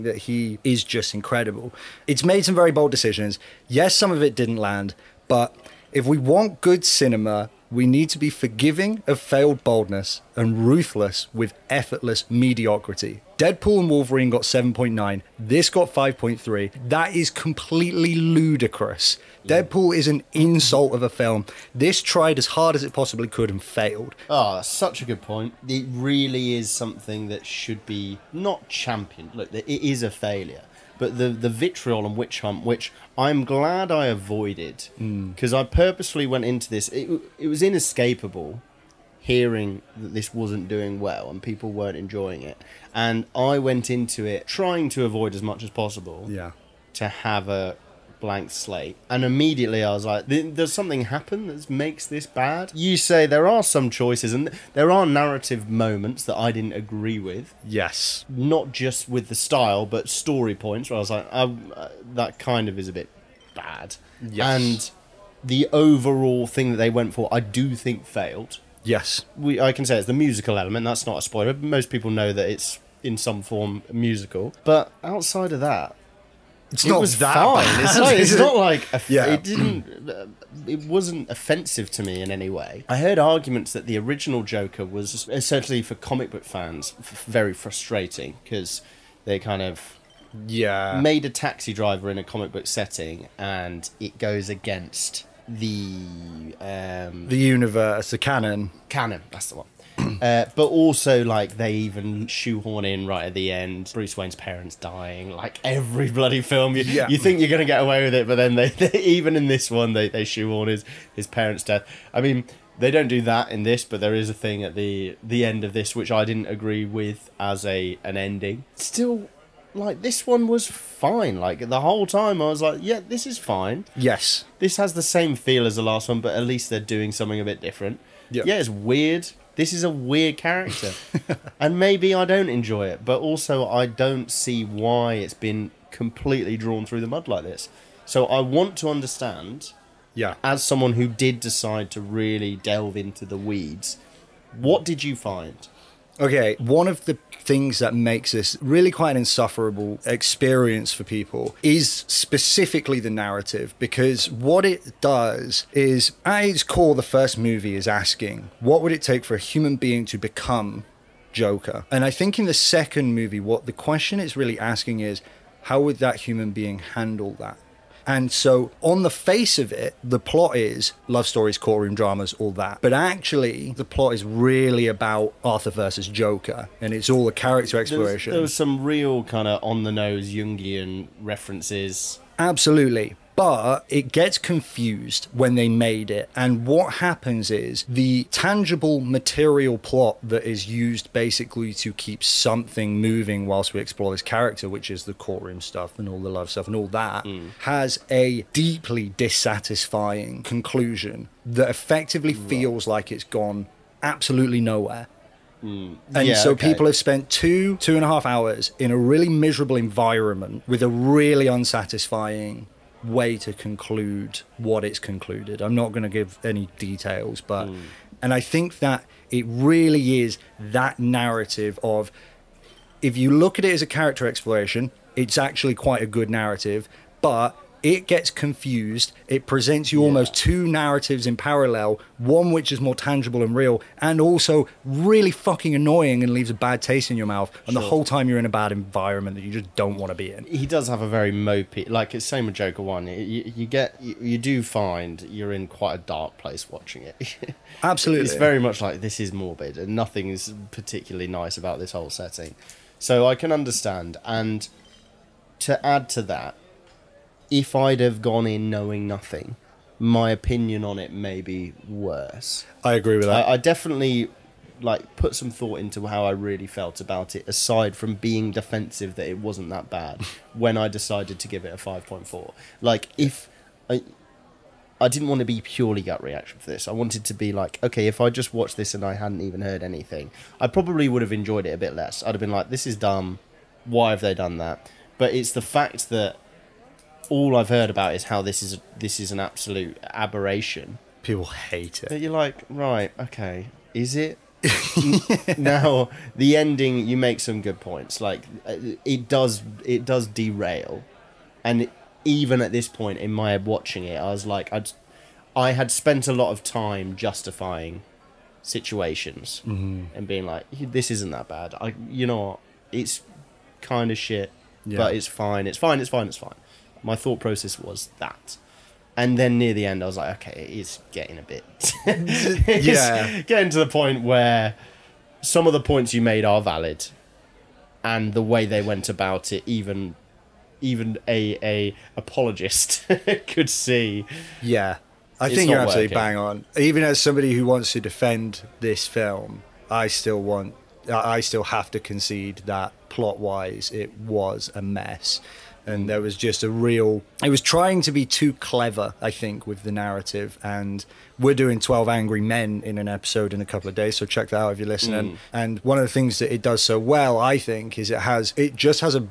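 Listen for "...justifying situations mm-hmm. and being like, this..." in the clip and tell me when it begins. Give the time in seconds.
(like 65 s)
307 s.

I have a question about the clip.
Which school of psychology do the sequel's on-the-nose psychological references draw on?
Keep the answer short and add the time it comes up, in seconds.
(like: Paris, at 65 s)
Jungian, at 180 s.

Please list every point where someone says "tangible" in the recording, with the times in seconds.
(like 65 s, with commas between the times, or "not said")
188 s, 232 s.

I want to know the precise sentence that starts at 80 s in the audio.
Uh, it wasn't offensive to me in any way.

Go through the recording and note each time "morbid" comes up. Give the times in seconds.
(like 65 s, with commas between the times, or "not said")
249 s.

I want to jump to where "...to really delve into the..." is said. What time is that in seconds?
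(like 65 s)
141 s.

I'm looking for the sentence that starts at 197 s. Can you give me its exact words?
has a deeply dissatisfying conclusion that effectively right.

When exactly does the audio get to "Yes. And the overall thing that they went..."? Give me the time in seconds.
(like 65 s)
64 s.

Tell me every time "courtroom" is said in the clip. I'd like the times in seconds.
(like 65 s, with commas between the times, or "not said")
171 s, 195 s.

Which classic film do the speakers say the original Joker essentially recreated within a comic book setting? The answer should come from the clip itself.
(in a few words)
Taxi Driver.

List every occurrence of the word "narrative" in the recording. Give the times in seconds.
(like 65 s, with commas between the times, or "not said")
55 s, 153 s, 220 s, 226 s, 230 s, 349 s.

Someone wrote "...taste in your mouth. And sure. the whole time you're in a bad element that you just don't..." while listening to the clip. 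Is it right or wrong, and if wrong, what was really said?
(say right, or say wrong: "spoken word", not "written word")
wrong: "environment", not "element".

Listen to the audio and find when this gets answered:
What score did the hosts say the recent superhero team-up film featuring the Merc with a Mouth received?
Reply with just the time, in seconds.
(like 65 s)
14 s.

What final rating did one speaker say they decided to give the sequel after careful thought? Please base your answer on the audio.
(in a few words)
5.4.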